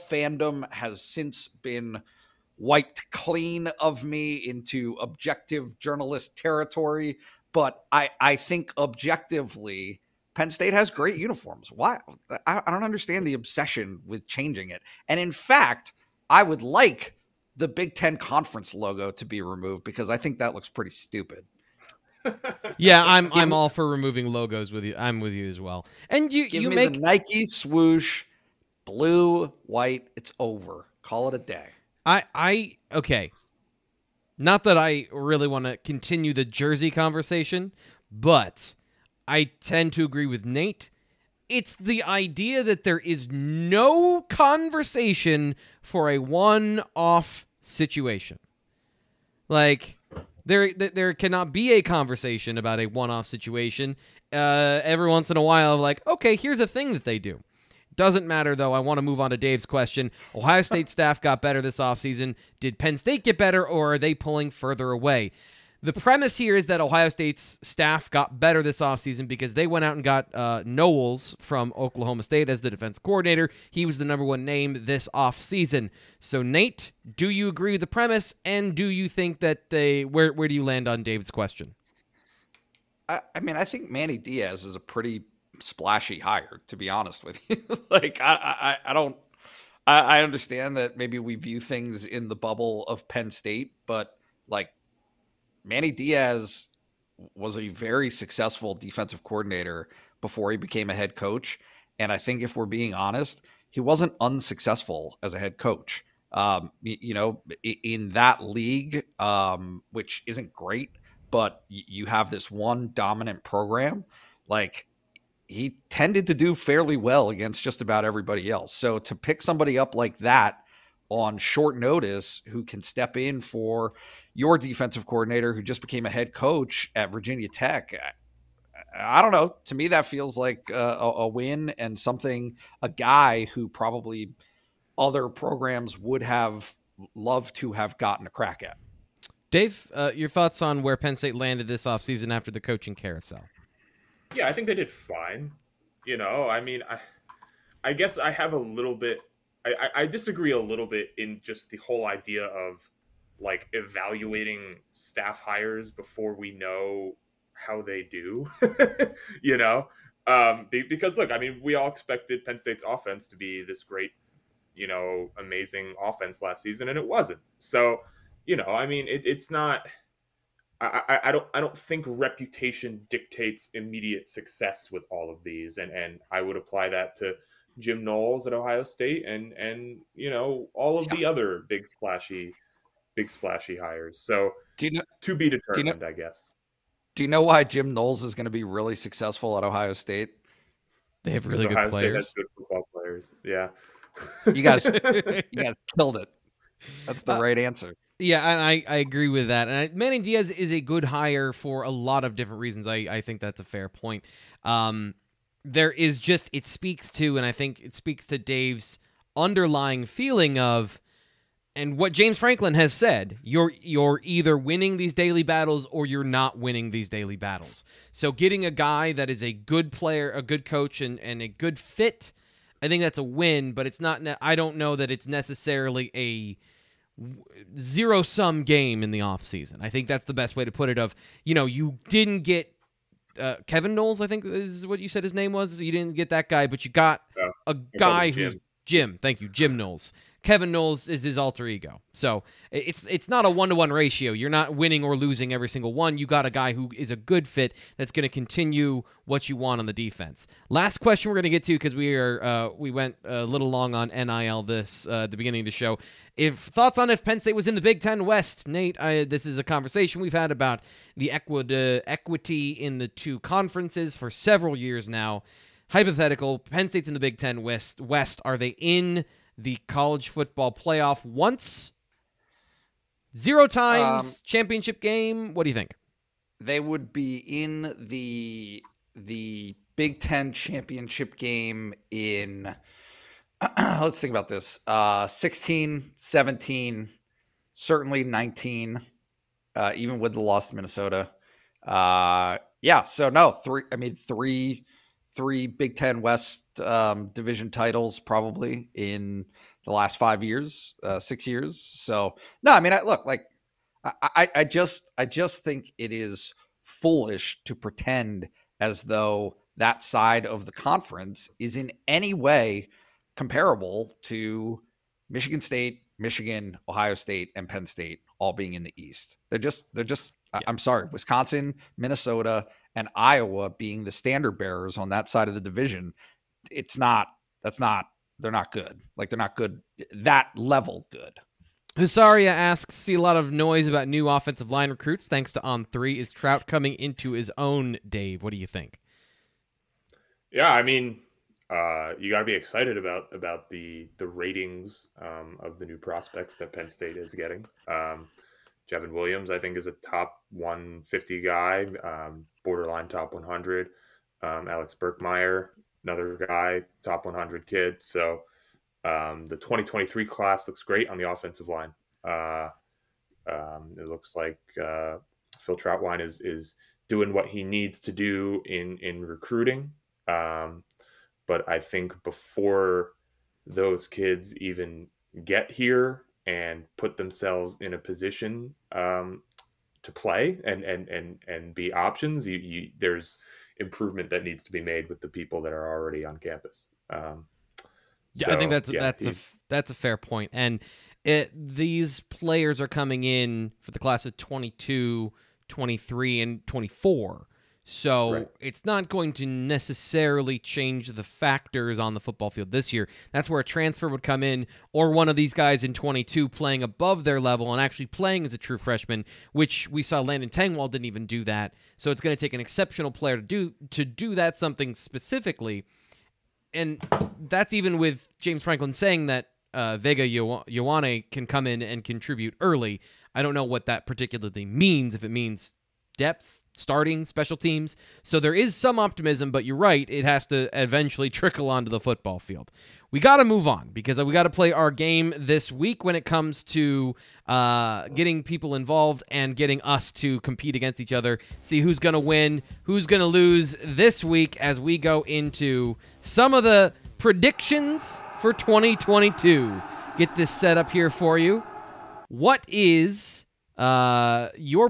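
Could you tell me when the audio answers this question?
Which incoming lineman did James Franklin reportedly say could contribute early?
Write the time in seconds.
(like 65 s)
419 s.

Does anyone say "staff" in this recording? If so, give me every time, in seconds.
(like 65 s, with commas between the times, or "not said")
60 s, 67 s, 154 s.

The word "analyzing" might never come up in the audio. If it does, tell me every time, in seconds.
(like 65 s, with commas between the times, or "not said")
not said.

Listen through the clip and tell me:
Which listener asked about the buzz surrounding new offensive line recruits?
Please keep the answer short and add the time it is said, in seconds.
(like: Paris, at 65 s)
Husaria, at 331 s.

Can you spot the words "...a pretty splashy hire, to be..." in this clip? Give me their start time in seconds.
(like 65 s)
84 s.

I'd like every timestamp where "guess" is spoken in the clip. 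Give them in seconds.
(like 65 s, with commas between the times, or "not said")
147 s, 186 s.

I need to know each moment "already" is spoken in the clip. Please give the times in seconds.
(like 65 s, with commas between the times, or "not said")
385 s.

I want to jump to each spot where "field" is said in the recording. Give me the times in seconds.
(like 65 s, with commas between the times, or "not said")
402 s, 432 s.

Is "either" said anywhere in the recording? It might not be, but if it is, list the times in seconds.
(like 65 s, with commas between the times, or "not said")
214 s.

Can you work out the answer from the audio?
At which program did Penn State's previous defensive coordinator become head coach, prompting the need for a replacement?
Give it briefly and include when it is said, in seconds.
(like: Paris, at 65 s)
Virginia Tech, at 127 s.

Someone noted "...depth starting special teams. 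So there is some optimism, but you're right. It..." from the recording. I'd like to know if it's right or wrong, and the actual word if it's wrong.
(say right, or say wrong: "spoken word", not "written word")
right.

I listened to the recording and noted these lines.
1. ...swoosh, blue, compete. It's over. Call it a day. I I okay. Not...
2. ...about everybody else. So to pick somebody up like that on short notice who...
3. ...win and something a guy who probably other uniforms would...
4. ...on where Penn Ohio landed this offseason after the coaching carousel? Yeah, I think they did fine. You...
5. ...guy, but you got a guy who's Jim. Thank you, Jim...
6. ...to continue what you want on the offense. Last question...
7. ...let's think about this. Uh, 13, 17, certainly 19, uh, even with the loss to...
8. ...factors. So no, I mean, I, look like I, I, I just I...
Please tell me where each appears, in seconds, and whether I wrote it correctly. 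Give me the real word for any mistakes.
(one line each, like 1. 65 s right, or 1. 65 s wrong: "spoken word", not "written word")
1. 27 s wrong: "white", not "compete"
2. 117 s right
3. 131 s wrong: "programs", not "uniforms"
4. 140 s wrong: "State", not "Ohio"
5. 236 s right
6. 248 s wrong: "defense", not "offense"
7. 283 s wrong: "16", not "13"
8. 301 s wrong: "years", not "factors".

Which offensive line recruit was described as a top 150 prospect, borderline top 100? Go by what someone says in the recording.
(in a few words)
J'ven Williams.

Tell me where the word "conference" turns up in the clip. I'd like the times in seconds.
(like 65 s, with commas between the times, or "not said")
18 s, 263 s, 310 s.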